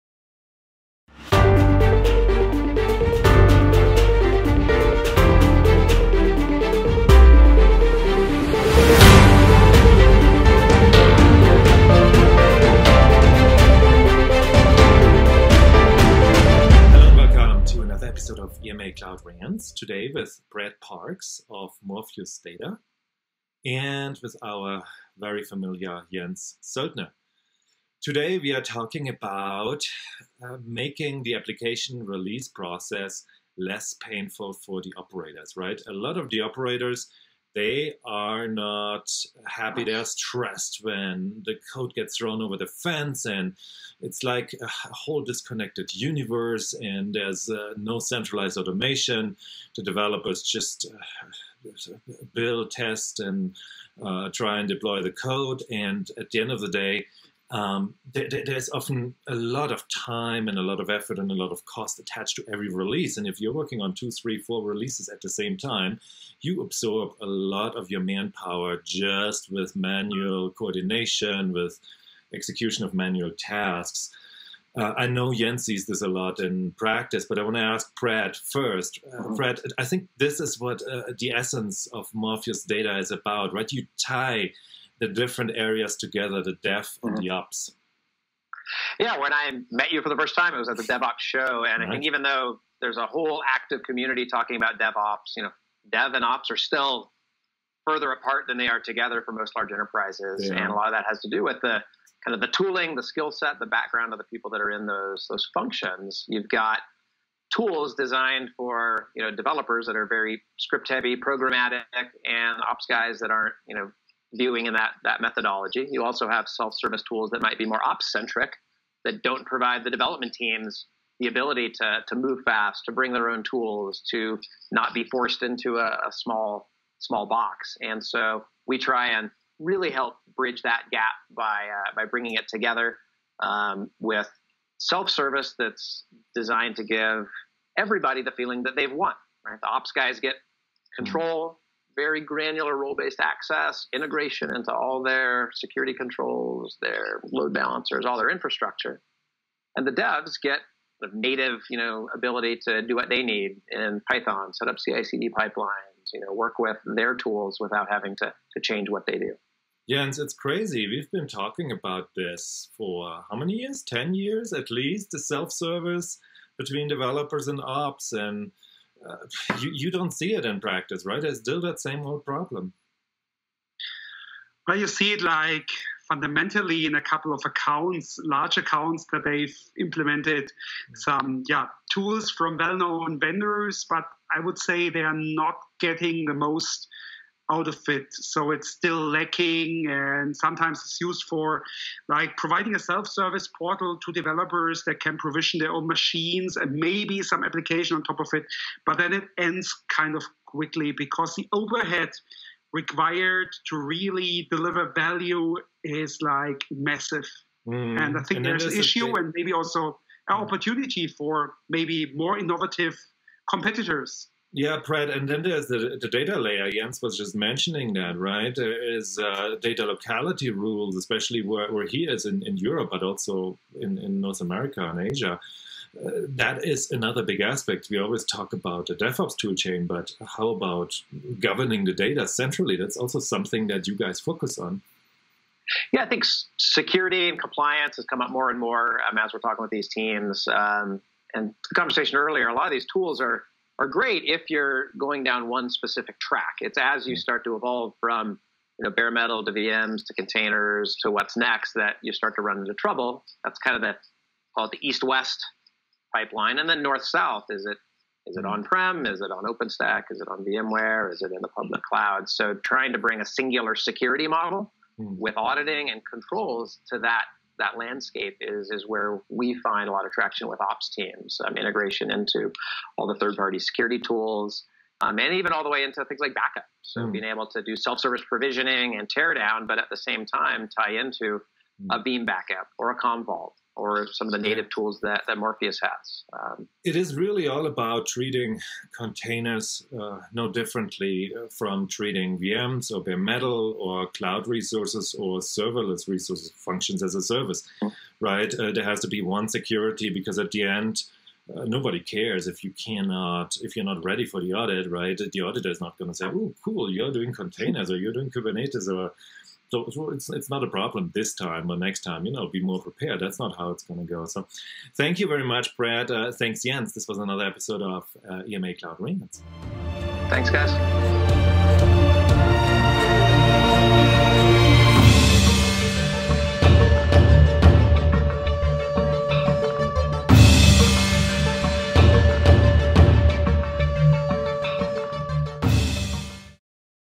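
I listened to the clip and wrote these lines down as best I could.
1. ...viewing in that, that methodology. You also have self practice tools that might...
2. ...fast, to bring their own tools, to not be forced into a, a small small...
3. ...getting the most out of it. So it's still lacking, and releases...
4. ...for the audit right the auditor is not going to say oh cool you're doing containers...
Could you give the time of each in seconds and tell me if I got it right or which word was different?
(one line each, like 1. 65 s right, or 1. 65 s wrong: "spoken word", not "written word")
1. 114 s wrong: "service", not "practice"
2. 122 s right
3. 185 s wrong: "sometimes", not "releases"
4. 304 s right.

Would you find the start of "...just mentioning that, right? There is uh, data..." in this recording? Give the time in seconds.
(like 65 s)
217 s.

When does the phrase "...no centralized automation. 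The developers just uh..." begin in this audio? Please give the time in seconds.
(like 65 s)
47 s.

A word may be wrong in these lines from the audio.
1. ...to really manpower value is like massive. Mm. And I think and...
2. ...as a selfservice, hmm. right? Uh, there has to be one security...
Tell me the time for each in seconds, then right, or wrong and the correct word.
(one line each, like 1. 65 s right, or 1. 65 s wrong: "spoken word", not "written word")
1. 203 s wrong: "deliver", not "manpower"
2. 297 s wrong: "service", not "selfservice".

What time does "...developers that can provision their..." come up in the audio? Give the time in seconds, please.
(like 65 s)
194 s.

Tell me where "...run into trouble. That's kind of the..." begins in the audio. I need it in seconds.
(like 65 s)
252 s.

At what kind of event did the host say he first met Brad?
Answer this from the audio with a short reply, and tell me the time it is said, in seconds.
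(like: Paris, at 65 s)
DevOps show, at 90 s.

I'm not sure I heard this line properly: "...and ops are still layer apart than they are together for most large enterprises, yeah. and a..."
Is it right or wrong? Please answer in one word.
wrong.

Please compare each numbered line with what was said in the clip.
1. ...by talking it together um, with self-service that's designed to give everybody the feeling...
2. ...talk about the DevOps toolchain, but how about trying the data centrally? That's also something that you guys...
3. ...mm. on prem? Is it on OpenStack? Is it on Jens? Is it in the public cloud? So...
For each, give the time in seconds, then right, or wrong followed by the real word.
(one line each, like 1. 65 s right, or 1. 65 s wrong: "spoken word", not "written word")
1. 131 s wrong: "bringing", not "talking"
2. 228 s wrong: "governing", not "trying"
3. 258 s wrong: "VMware", not "Jens".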